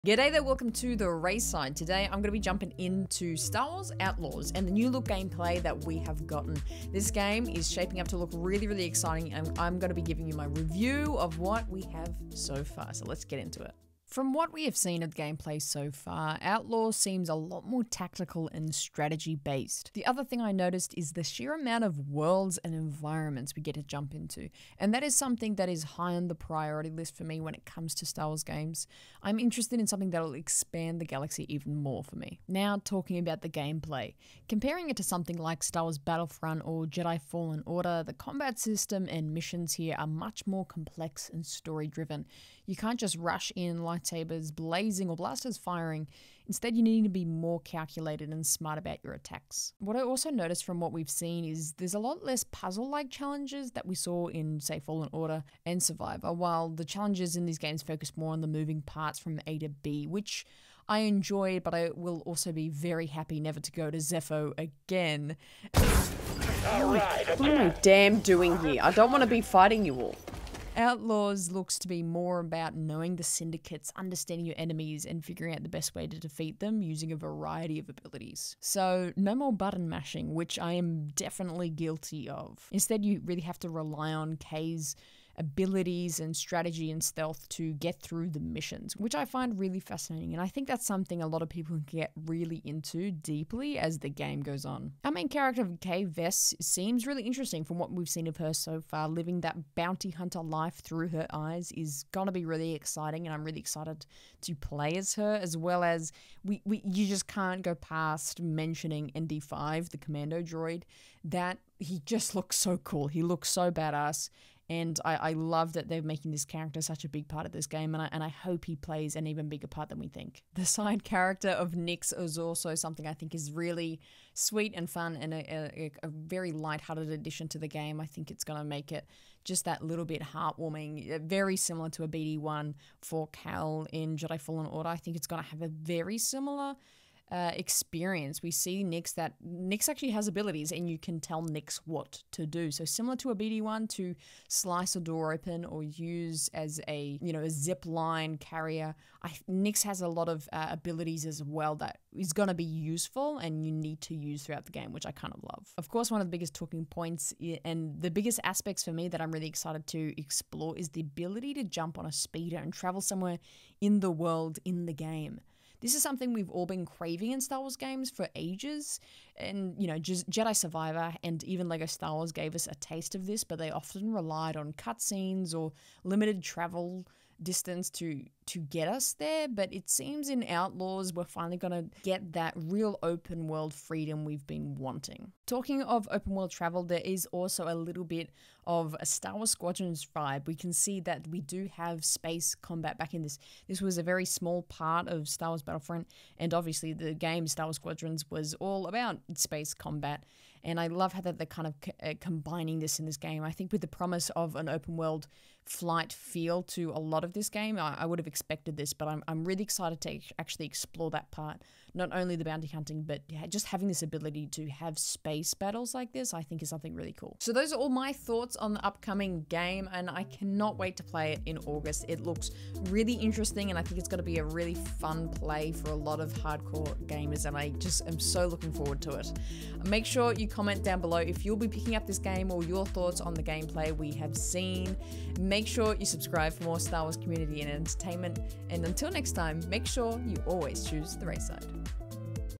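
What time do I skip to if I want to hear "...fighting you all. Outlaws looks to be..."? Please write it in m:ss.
1:09.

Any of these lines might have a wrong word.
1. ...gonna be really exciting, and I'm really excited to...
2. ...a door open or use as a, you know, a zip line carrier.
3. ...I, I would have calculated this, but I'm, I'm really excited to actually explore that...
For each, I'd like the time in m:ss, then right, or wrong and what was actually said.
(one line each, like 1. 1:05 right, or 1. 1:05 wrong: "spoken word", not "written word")
1. 1:42 right
2. 2:24 right
3. 3:27 wrong: "expected", not "calculated".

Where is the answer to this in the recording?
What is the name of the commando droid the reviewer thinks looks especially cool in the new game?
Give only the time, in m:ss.
1:49.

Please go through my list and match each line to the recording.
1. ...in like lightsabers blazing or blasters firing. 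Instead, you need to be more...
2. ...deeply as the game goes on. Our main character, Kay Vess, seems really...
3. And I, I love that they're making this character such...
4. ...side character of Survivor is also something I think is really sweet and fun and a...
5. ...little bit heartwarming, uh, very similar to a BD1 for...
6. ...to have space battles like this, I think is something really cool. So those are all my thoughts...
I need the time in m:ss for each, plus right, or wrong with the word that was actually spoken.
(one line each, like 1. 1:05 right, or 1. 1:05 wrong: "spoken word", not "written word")
1. 0:43 right
2. 1:33 right
3. 1:54 right
4. 2:00 wrong: "Nix", not "Survivor"
5. 2:09 right
6. 3:34 right.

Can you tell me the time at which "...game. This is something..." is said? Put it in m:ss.
2:44.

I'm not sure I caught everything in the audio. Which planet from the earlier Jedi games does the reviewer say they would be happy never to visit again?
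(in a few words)
Zeffo.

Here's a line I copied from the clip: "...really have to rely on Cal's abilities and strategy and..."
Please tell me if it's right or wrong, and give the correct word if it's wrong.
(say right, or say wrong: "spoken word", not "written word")
wrong: "Kay", not "Cal".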